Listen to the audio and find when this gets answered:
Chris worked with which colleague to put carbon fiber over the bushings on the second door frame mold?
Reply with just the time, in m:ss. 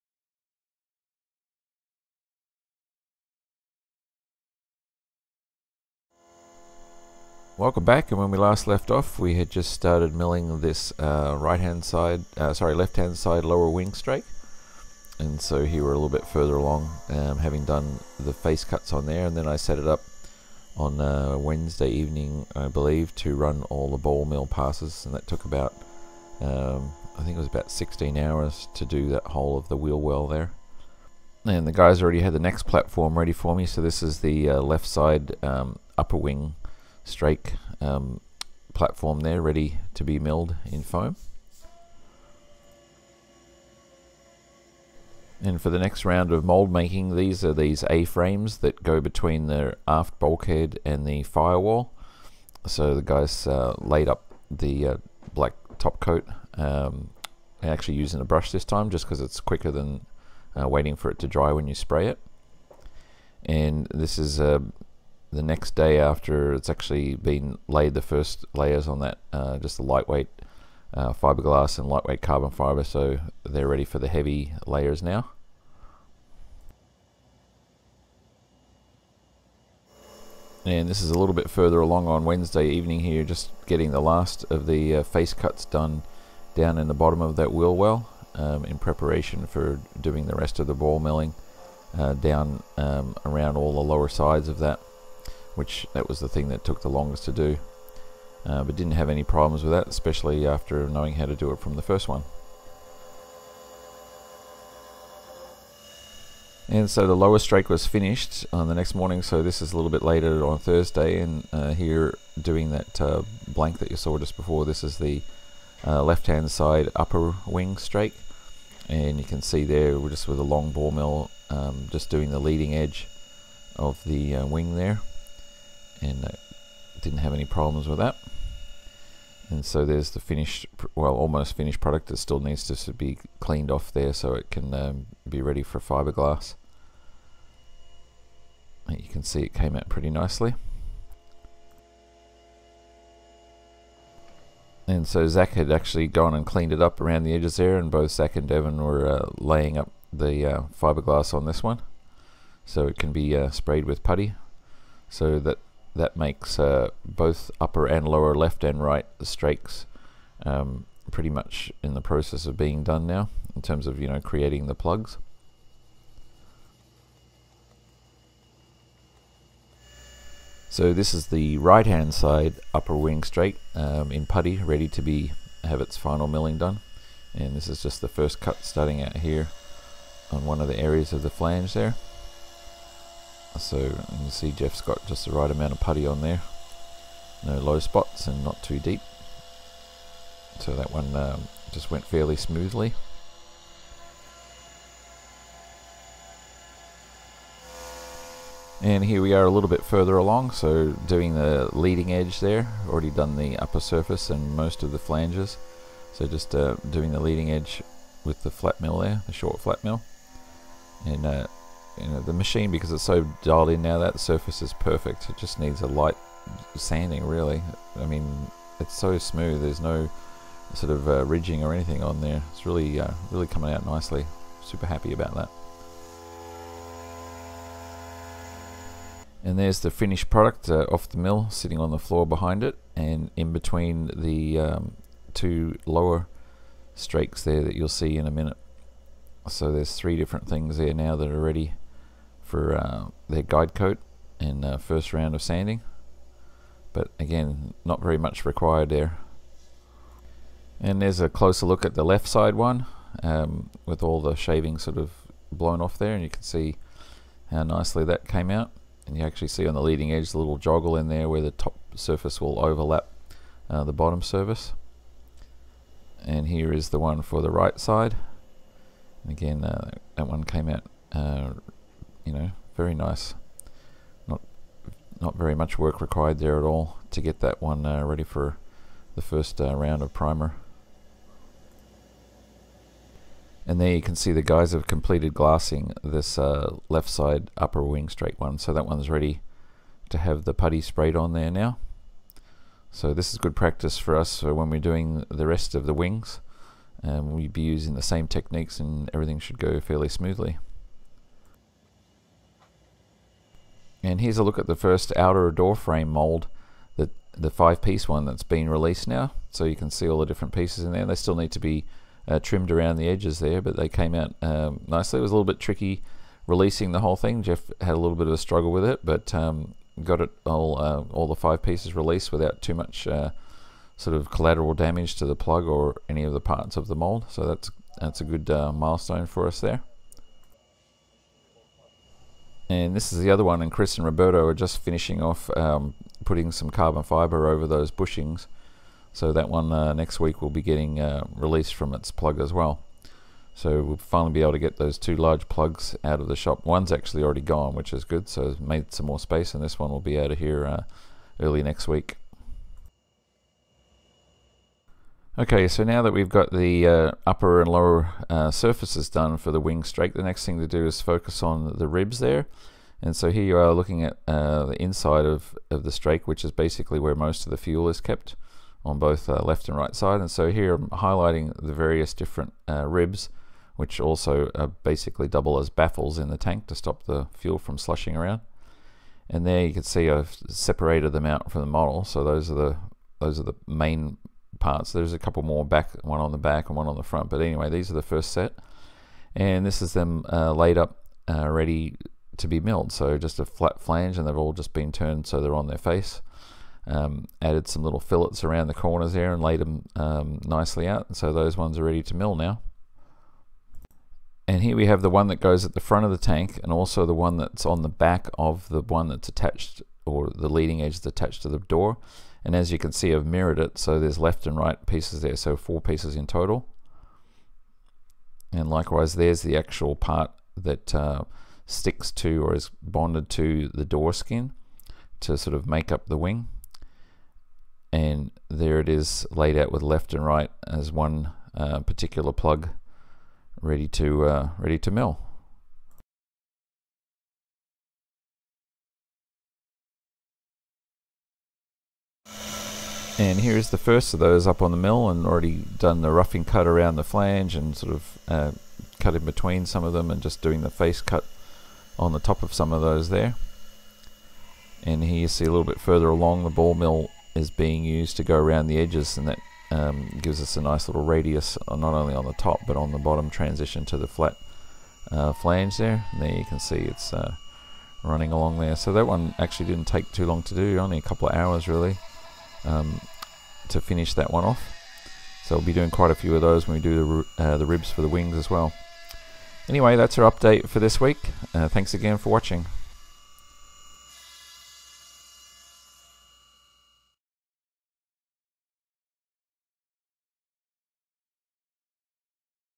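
5:34.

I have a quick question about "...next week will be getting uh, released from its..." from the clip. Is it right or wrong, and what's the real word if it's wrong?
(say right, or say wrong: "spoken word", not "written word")
right.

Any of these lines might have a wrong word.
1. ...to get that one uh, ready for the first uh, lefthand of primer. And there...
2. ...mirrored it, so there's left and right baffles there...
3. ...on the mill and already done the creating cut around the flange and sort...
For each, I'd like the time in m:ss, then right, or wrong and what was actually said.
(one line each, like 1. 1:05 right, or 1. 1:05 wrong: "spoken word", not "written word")
1. 4:37 wrong: "round", not "lefthand"
2. 6:53 wrong: "pieces", not "baffles"
3. 7:24 wrong: "roughing", not "creating".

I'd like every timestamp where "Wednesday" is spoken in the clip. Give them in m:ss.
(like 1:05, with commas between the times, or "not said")
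0:21, 1:22.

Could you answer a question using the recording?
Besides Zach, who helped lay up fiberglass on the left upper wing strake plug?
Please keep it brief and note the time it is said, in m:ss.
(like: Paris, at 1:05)
Evan, at 2:28.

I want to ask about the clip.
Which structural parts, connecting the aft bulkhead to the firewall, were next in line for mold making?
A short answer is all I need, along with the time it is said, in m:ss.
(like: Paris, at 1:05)
A-frames, at 0:47.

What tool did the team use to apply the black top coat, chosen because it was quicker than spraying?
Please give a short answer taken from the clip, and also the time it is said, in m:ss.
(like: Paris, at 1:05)
A brush, at 0:58.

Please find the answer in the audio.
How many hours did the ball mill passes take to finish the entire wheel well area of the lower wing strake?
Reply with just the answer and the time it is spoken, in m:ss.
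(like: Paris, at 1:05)
16, at 0:27.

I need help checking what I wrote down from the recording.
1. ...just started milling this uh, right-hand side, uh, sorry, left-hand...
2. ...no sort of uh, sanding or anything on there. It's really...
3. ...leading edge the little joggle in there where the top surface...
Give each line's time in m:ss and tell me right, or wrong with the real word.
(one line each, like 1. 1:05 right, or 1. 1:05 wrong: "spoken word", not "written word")
1. 0:09 right
2. 3:39 wrong: "ridging", not "sanding"
3. 4:19 right.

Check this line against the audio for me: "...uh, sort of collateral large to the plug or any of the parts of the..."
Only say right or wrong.
wrong.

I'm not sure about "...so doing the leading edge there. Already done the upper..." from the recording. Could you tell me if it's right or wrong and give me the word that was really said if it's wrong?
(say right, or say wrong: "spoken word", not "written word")
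right.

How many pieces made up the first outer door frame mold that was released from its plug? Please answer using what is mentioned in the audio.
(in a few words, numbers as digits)
5.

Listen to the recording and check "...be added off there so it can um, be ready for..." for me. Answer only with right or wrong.
wrong.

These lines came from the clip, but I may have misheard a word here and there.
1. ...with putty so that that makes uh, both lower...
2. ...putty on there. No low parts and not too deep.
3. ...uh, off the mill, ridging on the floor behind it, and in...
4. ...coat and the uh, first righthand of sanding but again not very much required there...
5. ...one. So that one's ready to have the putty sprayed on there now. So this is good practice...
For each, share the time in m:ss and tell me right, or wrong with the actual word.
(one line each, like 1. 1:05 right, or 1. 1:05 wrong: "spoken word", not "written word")
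1. 2:33 wrong: "upper", not "lower"
2. 3:05 wrong: "spots", not "parts"
3. 3:50 wrong: "sitting", not "ridging"
4. 4:03 wrong: "round", not "righthand"
5. 4:48 right.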